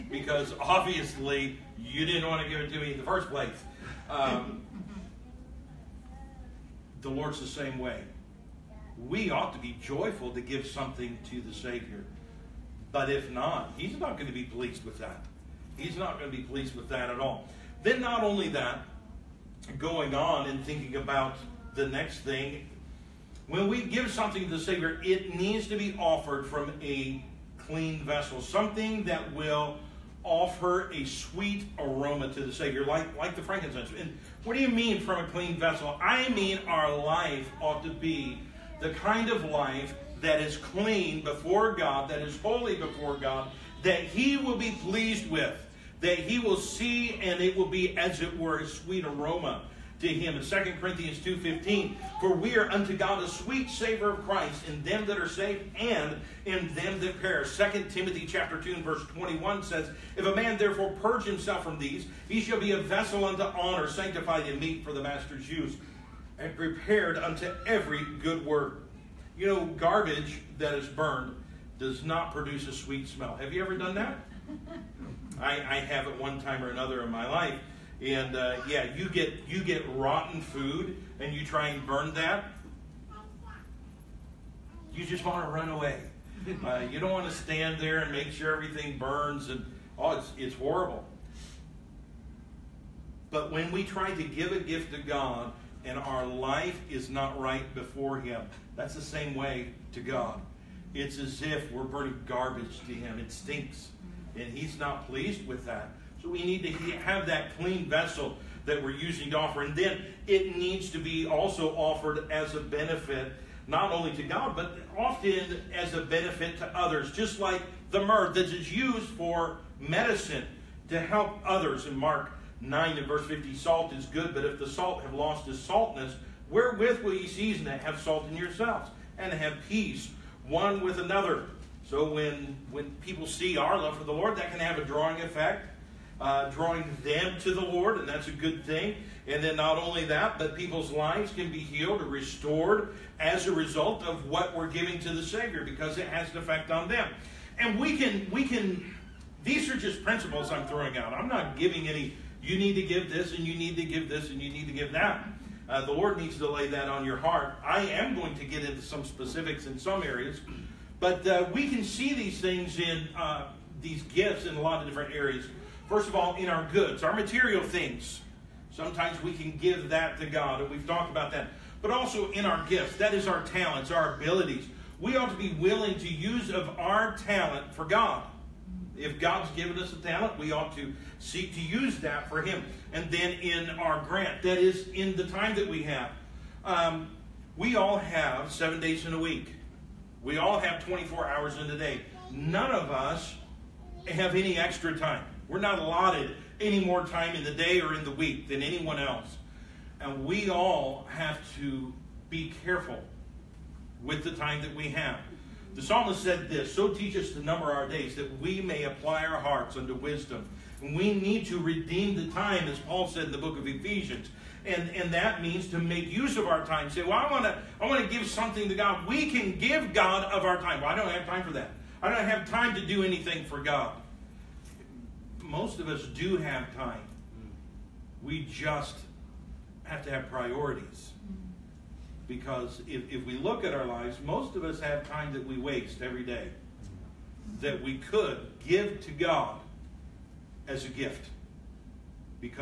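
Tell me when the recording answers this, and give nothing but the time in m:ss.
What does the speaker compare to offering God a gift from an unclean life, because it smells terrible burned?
1:19.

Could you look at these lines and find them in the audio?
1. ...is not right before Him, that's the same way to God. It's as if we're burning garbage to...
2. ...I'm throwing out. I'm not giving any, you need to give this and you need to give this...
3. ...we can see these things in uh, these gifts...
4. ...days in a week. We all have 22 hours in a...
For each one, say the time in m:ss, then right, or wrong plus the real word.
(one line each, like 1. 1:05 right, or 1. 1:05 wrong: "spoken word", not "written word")
1. 1:36 right
2. 2:30 right
3. 2:41 right
4. 3:08 wrong: "24", not "22".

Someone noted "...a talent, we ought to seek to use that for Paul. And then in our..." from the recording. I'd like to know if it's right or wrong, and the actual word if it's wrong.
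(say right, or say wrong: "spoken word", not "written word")
wrong: "Him", not "Paul".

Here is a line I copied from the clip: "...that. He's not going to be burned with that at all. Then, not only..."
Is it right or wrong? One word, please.
wrong.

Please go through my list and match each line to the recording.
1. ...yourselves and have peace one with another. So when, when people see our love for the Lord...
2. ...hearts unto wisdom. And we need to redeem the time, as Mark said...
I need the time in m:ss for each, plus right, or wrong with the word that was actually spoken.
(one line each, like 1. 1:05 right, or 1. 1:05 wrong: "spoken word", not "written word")
1. 2:08 right
2. 3:29 wrong: "Paul", not "Mark".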